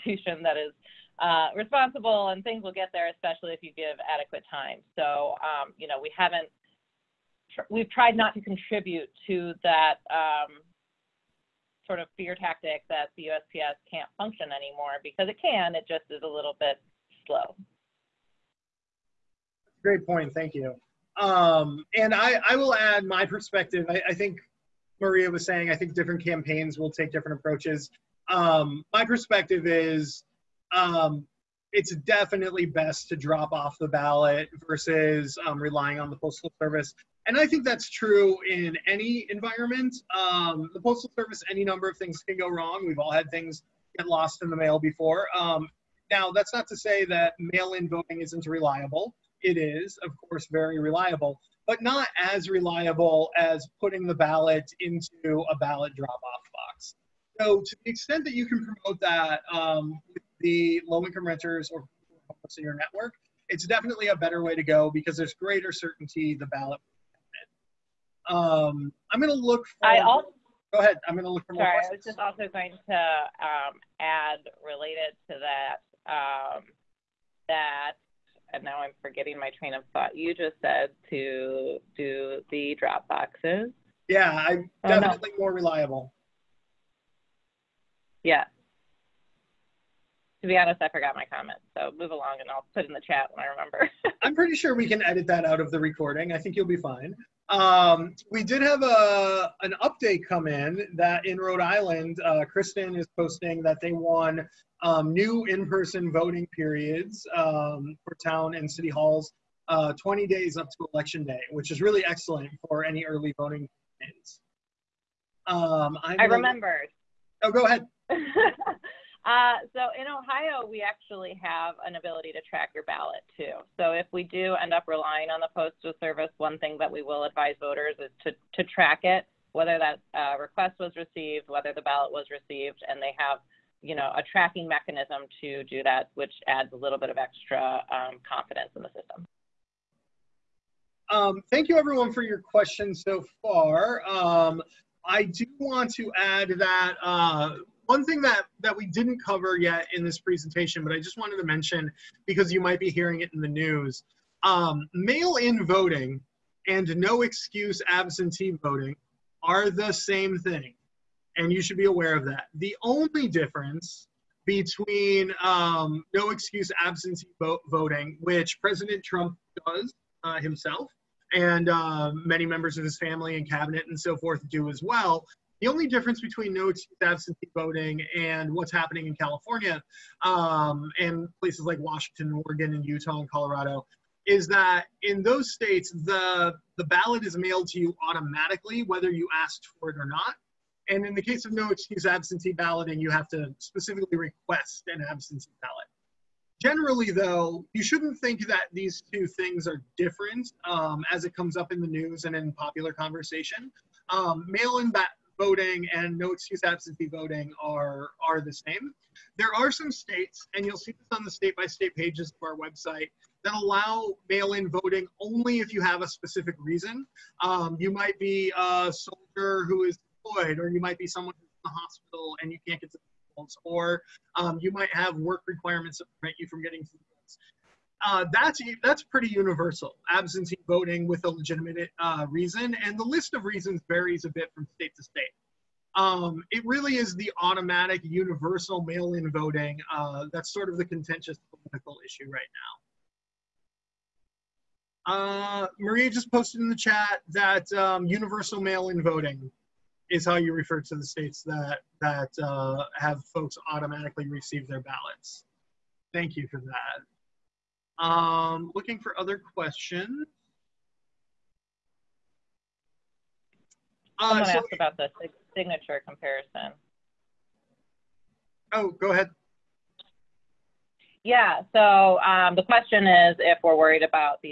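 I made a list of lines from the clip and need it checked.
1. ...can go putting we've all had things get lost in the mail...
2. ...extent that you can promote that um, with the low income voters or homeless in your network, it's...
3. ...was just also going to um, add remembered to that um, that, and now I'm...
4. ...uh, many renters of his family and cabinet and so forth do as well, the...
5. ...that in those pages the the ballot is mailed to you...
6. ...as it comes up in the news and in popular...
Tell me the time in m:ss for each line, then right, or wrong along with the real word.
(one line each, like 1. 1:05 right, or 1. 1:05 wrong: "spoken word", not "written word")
1. 0:42 wrong: "wrong", not "putting"
2. 0:57 wrong: "renters", not "voters"
3. 1:11 wrong: "related", not "remembered"
4. 2:51 wrong: "members", not "renters"
5. 3:04 wrong: "states", not "pages"
6. 3:21 right.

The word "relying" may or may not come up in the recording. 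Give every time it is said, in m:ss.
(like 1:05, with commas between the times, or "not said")
0:35, 2:04.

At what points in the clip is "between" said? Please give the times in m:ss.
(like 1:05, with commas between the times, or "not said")
2:44, 2:56.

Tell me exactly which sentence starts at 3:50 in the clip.
Absentee voting with a legitimate uh, reason, and the list of reasons varies a bit from state to state.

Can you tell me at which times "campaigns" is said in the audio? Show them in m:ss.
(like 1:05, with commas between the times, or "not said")
0:26, 1:53.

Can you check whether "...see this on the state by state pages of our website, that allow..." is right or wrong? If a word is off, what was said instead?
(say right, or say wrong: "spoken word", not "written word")
right.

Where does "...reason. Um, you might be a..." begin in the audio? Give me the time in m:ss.
3:36.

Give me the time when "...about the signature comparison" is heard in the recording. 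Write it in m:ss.
4:24.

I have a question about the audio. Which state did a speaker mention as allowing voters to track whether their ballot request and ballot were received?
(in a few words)
Ohio.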